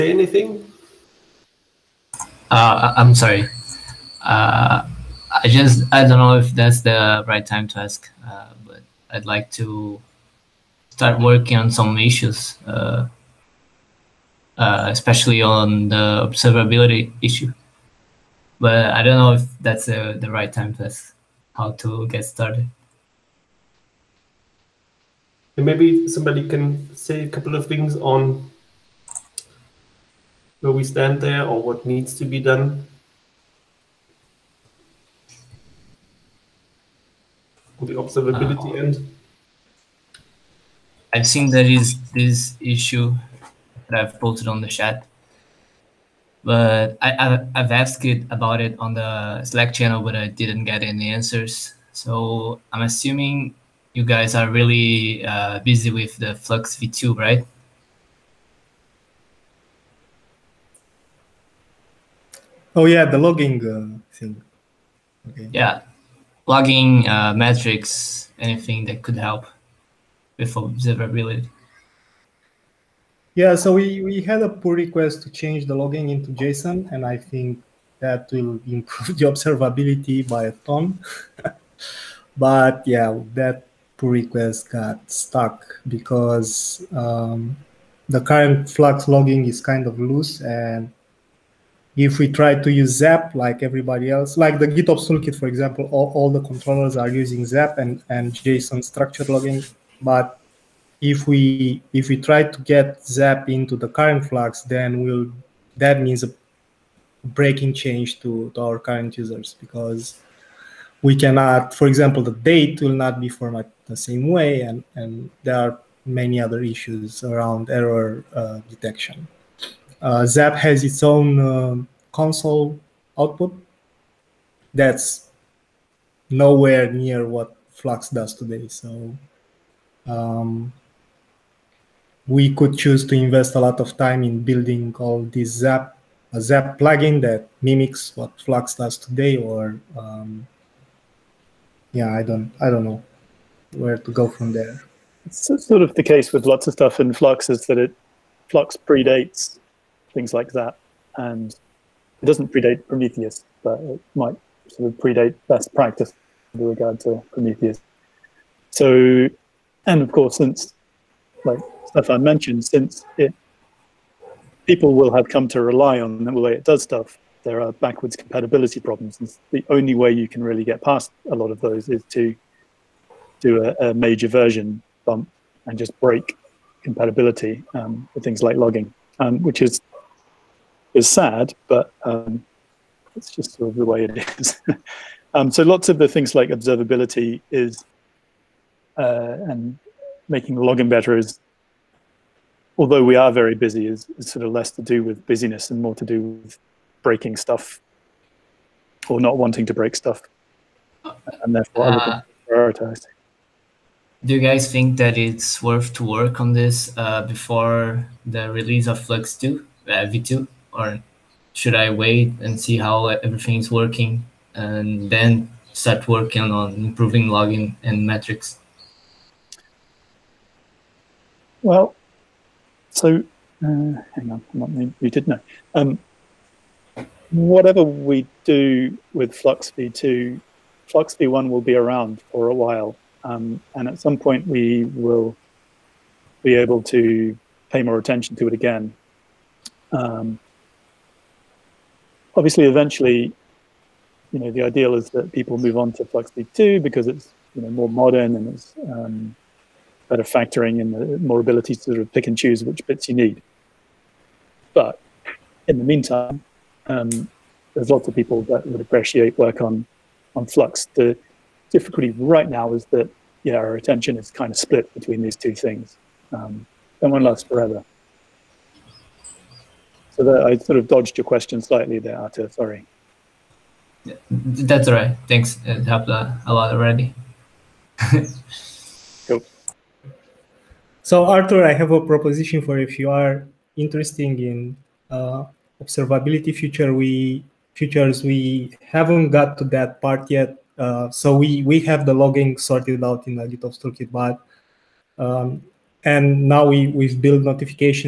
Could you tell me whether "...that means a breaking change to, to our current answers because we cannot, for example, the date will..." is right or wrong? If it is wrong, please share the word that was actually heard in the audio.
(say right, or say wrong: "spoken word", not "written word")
wrong: "users", not "answers".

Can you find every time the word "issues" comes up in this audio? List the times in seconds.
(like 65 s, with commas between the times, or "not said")
11 s, 17 s, 42 s, 116 s.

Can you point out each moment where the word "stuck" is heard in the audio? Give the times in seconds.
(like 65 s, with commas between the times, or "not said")
85 s.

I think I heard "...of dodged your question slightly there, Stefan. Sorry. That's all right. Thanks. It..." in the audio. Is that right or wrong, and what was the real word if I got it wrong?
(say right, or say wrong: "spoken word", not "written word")
wrong: "Arthur", not "Stefan".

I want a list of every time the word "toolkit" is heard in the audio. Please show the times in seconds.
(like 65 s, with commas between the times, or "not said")
95 s, 293 s.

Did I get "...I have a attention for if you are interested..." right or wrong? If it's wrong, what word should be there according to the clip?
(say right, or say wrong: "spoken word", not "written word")
wrong: "proposition", not "attention".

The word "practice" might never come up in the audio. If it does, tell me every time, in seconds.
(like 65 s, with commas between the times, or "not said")
155 s.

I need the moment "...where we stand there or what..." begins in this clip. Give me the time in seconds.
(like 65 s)
30 s.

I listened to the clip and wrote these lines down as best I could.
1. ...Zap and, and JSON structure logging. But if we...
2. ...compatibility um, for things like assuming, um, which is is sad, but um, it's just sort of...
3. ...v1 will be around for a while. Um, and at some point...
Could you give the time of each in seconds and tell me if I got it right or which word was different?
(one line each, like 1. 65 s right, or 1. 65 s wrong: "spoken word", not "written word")
1. 97 s right
2. 176 s wrong: "logging", not "assuming"
3. 231 s right.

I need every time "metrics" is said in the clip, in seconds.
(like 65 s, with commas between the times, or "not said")
67 s, 218 s.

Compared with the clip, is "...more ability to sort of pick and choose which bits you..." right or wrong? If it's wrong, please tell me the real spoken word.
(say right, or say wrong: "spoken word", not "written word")
right.